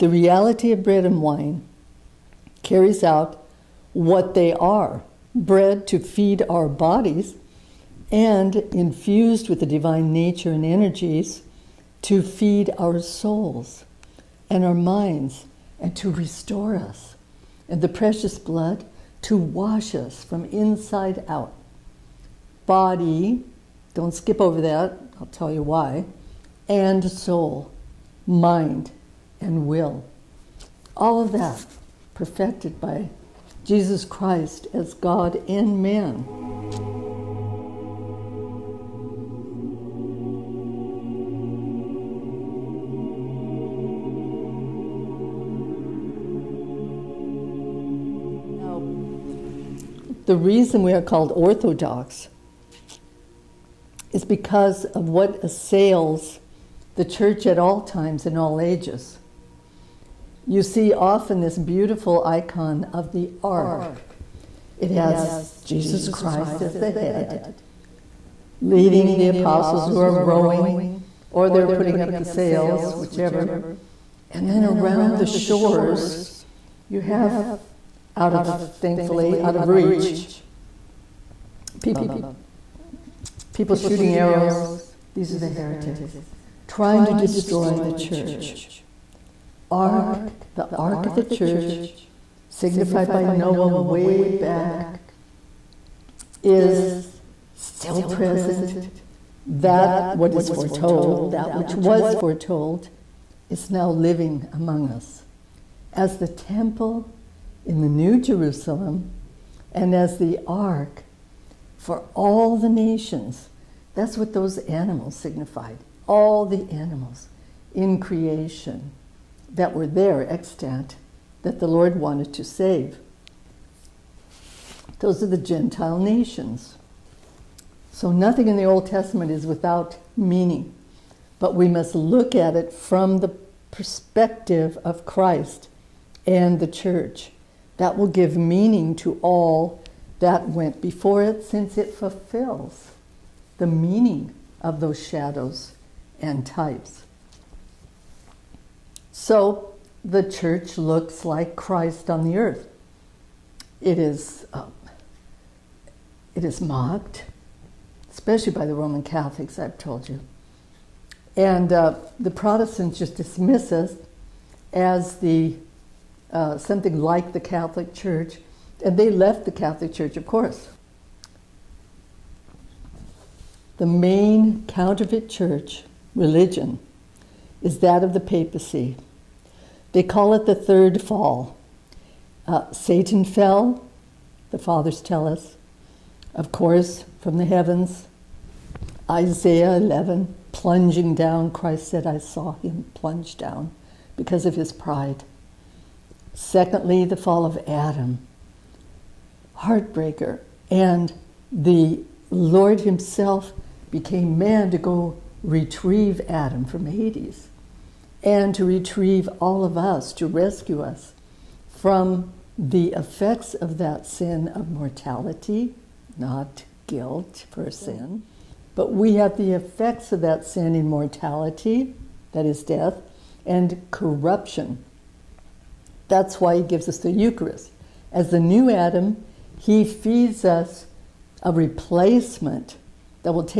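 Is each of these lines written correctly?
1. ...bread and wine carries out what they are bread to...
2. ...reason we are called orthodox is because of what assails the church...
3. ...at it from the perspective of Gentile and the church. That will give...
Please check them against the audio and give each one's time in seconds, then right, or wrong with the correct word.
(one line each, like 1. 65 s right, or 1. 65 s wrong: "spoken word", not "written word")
1. 0 s right
2. 50 s right
3. 132 s wrong: "Christ", not "Gentile".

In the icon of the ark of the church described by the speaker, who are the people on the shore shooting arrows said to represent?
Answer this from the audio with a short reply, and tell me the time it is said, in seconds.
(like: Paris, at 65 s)
The heretics, at 85 s.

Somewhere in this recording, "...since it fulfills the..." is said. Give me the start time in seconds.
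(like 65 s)
141 s.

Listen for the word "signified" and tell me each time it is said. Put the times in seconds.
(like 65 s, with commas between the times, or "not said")
92 s, 115 s.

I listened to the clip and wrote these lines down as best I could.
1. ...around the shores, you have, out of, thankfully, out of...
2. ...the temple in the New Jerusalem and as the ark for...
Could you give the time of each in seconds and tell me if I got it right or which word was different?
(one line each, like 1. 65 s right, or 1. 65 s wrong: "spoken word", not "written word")
1. 74 s right
2. 106 s right.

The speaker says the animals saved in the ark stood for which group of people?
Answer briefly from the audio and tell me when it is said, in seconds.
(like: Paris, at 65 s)
The Gentile nations, at 125 s.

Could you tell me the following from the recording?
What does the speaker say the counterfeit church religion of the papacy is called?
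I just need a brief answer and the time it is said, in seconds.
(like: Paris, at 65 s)
The third fall, at 180 s.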